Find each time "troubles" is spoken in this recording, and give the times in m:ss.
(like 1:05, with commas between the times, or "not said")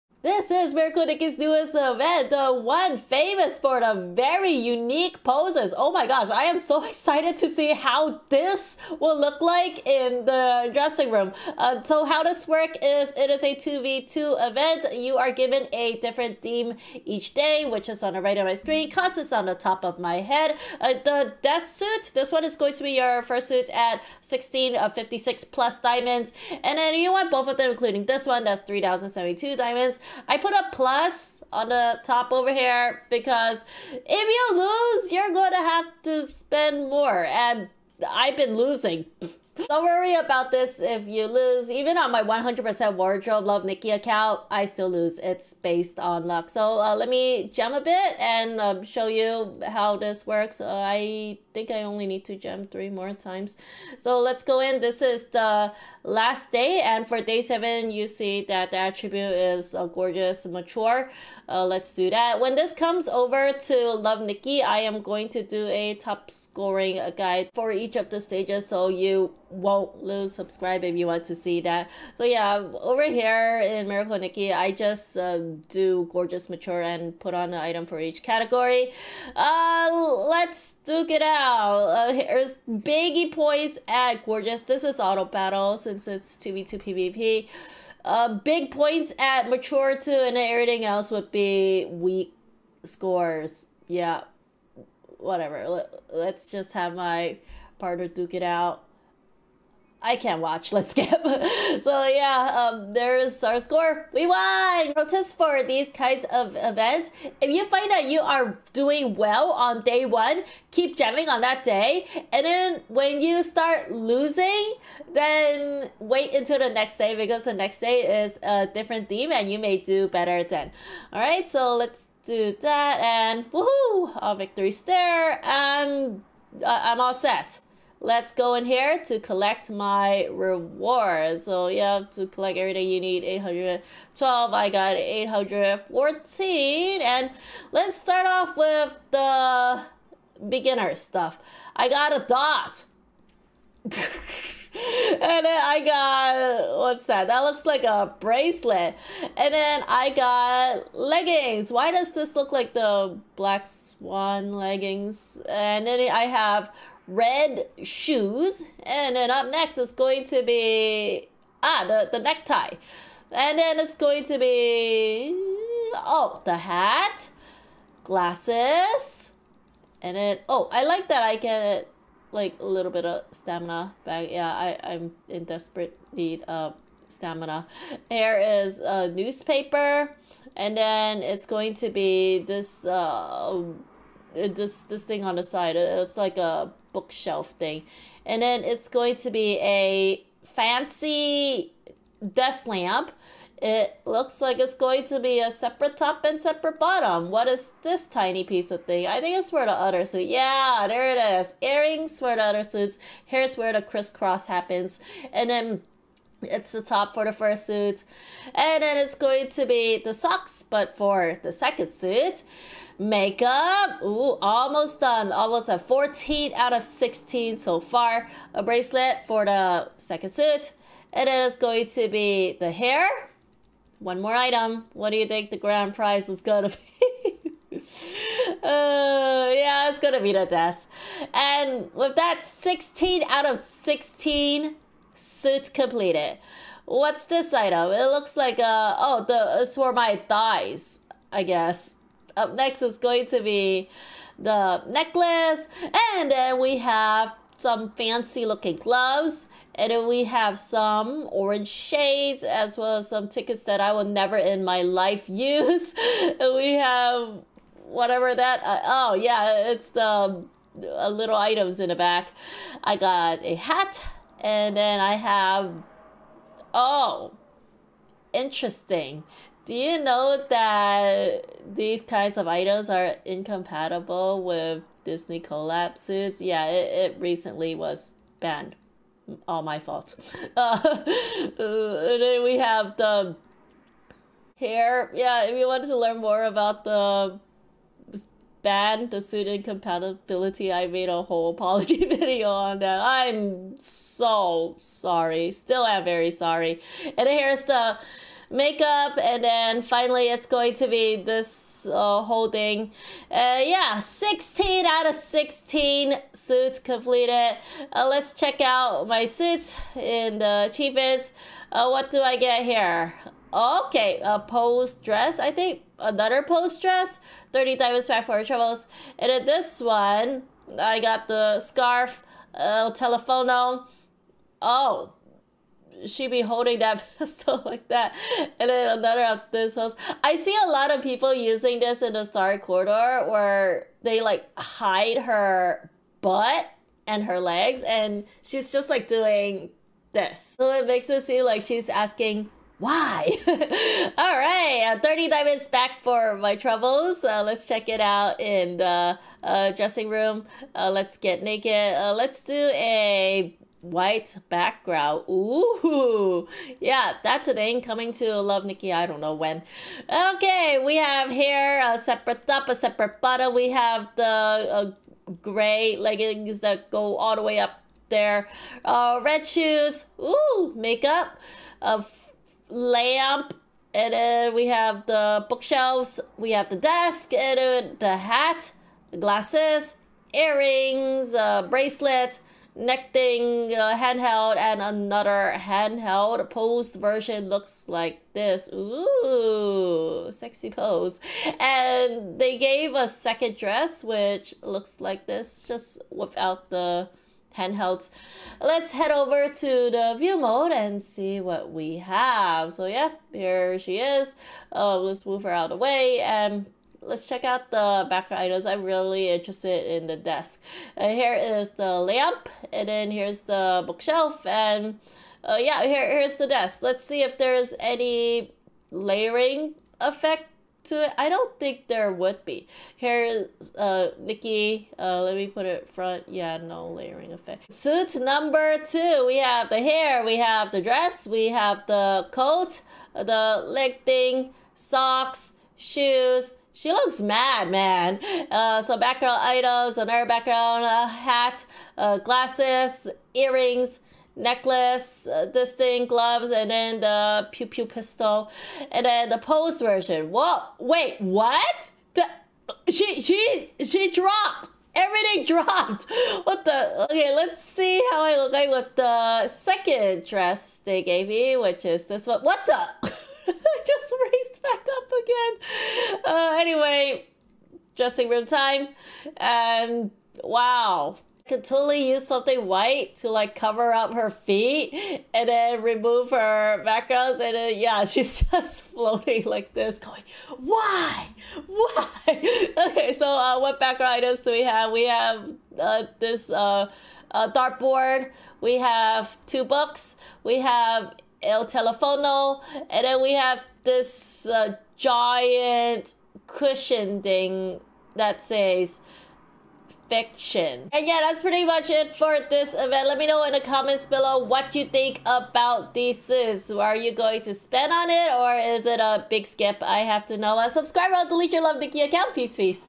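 5:18, 5:46.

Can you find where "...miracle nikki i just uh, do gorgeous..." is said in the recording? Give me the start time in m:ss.
1:13.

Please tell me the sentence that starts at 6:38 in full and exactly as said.
Let's head over to the view mode and see what we have.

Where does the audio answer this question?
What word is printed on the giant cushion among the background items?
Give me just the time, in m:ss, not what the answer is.
8:20.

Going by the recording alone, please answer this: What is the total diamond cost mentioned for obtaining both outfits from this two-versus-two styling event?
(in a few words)
3,072 diamonds.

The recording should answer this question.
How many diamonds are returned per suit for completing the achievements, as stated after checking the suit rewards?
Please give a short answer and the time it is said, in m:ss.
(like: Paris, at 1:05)
30, at 5:45.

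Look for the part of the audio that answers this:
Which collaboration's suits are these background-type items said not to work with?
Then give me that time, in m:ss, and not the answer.
4:35.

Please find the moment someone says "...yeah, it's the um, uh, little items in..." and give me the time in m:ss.
4:19.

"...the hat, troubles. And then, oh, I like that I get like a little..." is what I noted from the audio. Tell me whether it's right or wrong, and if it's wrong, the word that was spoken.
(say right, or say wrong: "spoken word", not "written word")
wrong: "glasses", not "troubles".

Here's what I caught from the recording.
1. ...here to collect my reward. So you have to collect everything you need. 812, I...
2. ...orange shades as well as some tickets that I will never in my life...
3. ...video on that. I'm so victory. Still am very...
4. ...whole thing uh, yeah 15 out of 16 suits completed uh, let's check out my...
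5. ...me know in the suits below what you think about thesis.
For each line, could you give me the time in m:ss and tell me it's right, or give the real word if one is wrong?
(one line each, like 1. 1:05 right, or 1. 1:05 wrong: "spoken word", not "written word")
1. 2:08 right
2. 4:11 right
3. 4:52 wrong: "sorry", not "victory"
4. 5:02 wrong: "16", not "15"
5. 8:23 wrong: "comments", not "suits".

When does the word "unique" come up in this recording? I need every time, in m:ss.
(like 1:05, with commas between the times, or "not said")
0:04.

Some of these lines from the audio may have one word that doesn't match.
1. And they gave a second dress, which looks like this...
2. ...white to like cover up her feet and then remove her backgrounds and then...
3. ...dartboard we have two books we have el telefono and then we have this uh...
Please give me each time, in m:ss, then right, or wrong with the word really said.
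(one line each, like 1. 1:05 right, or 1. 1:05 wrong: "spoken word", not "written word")
1. 6:31 right
2. 7:52 right
3. 8:07 right.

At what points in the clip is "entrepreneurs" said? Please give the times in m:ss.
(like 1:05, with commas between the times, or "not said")
not said.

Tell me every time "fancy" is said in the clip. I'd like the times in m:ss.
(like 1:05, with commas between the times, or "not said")
3:10, 4:07.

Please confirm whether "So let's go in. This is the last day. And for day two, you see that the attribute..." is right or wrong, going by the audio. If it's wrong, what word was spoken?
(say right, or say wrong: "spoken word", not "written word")
wrong: "seven", not "two".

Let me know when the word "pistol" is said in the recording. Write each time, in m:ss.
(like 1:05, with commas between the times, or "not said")
5:27, 7:27.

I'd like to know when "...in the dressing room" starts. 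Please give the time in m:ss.
0:09.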